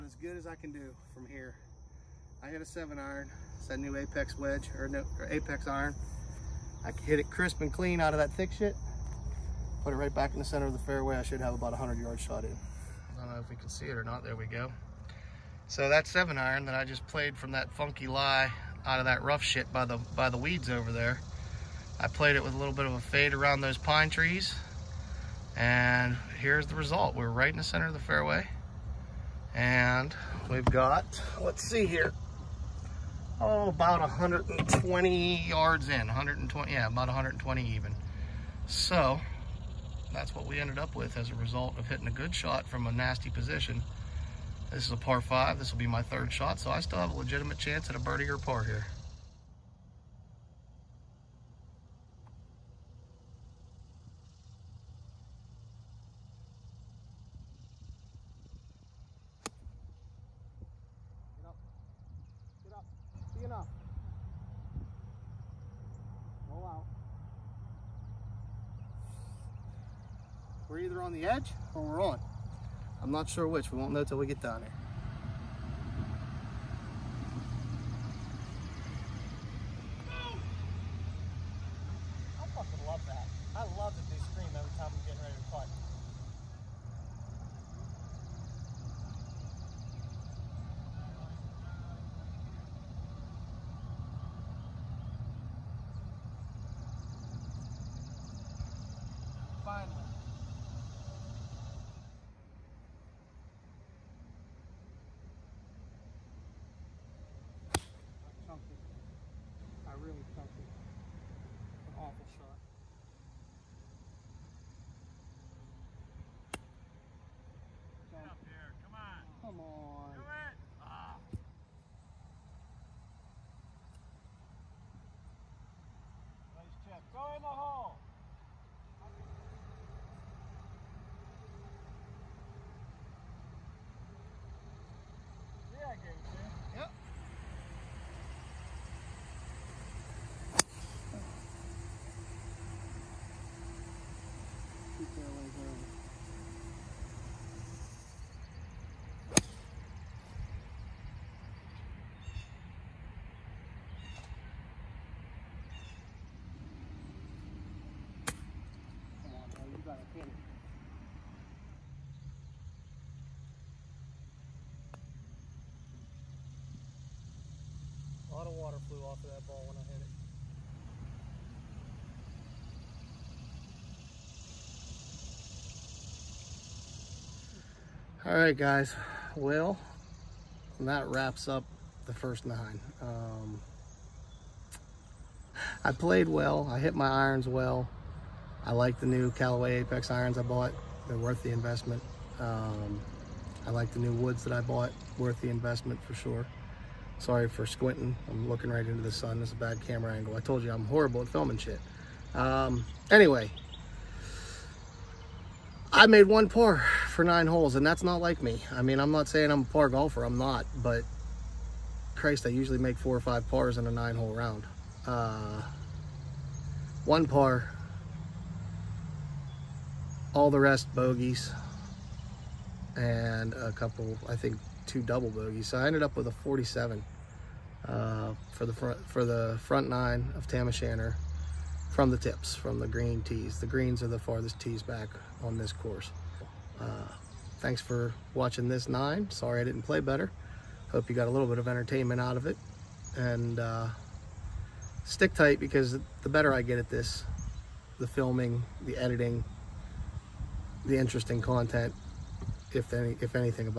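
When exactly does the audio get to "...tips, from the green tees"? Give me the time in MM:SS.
03:52.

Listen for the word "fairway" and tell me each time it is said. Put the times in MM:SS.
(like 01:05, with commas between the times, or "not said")
00:10, 00:27.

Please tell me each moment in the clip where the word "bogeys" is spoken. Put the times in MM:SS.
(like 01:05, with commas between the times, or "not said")
03:40, 03:45.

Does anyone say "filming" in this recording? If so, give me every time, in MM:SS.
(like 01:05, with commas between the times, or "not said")
03:21, 04:08.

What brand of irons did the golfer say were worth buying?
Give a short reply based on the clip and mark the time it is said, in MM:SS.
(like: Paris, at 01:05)
Callaway Apex, at 03:09.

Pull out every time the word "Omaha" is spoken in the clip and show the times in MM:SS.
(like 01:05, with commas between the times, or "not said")
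02:07.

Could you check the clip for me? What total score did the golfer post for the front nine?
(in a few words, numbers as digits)
47.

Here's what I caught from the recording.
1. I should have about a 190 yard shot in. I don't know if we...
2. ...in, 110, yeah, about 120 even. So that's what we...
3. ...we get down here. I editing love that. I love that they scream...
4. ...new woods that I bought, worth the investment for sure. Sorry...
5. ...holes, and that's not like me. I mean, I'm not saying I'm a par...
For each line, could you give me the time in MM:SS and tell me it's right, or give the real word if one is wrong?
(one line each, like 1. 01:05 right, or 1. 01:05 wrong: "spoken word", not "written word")
1. 00:11 wrong: "100", not "190"
2. 00:35 wrong: "120", not "110"
3. 01:14 wrong: "fucking", not "editing"
4. 03:13 right
5. 03:27 right.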